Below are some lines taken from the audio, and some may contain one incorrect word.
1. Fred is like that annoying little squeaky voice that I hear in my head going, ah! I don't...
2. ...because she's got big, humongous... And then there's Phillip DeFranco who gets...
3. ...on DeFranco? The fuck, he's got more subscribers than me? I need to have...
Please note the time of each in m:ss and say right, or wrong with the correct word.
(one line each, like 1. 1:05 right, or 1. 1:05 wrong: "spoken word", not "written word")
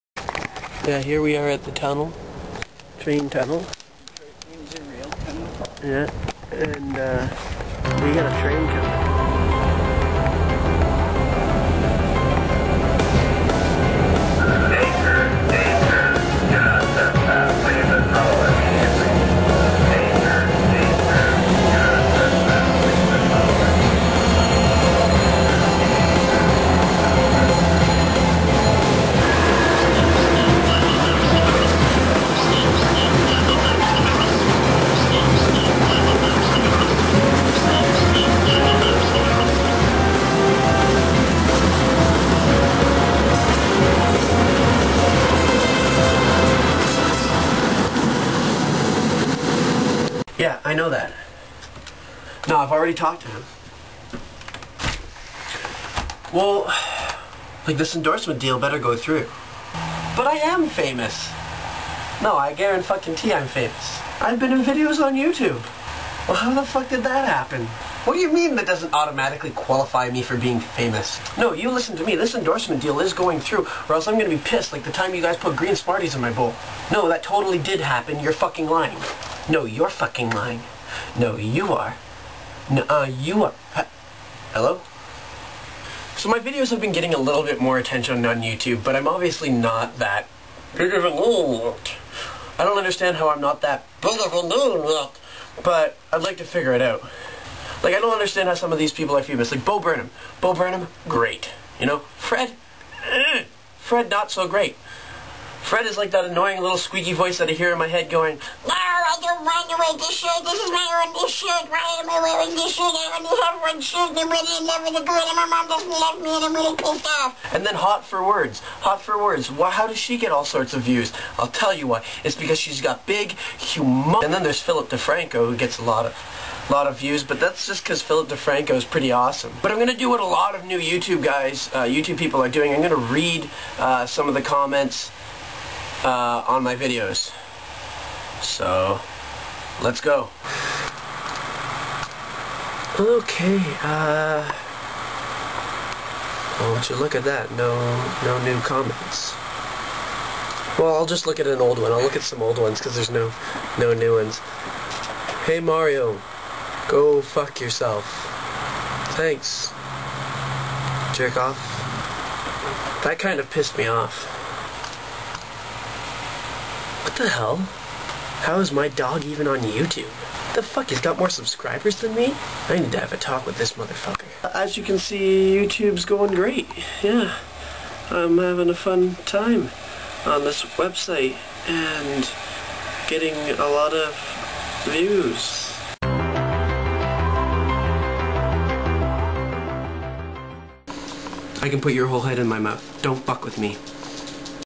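1. 1:45 right
2. 2:02 right
3. 2:49 wrong: "YouTube", not "DeFranco".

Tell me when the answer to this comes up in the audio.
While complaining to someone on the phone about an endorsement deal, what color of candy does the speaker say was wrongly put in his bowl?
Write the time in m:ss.
1:15.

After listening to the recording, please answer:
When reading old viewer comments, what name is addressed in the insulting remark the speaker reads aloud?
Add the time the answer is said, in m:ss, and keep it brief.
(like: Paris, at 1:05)
Mario, at 2:35.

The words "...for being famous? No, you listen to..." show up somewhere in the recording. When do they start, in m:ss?
1:10.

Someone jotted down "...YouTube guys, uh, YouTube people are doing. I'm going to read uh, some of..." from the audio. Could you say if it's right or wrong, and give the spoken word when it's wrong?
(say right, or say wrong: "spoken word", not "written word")
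right.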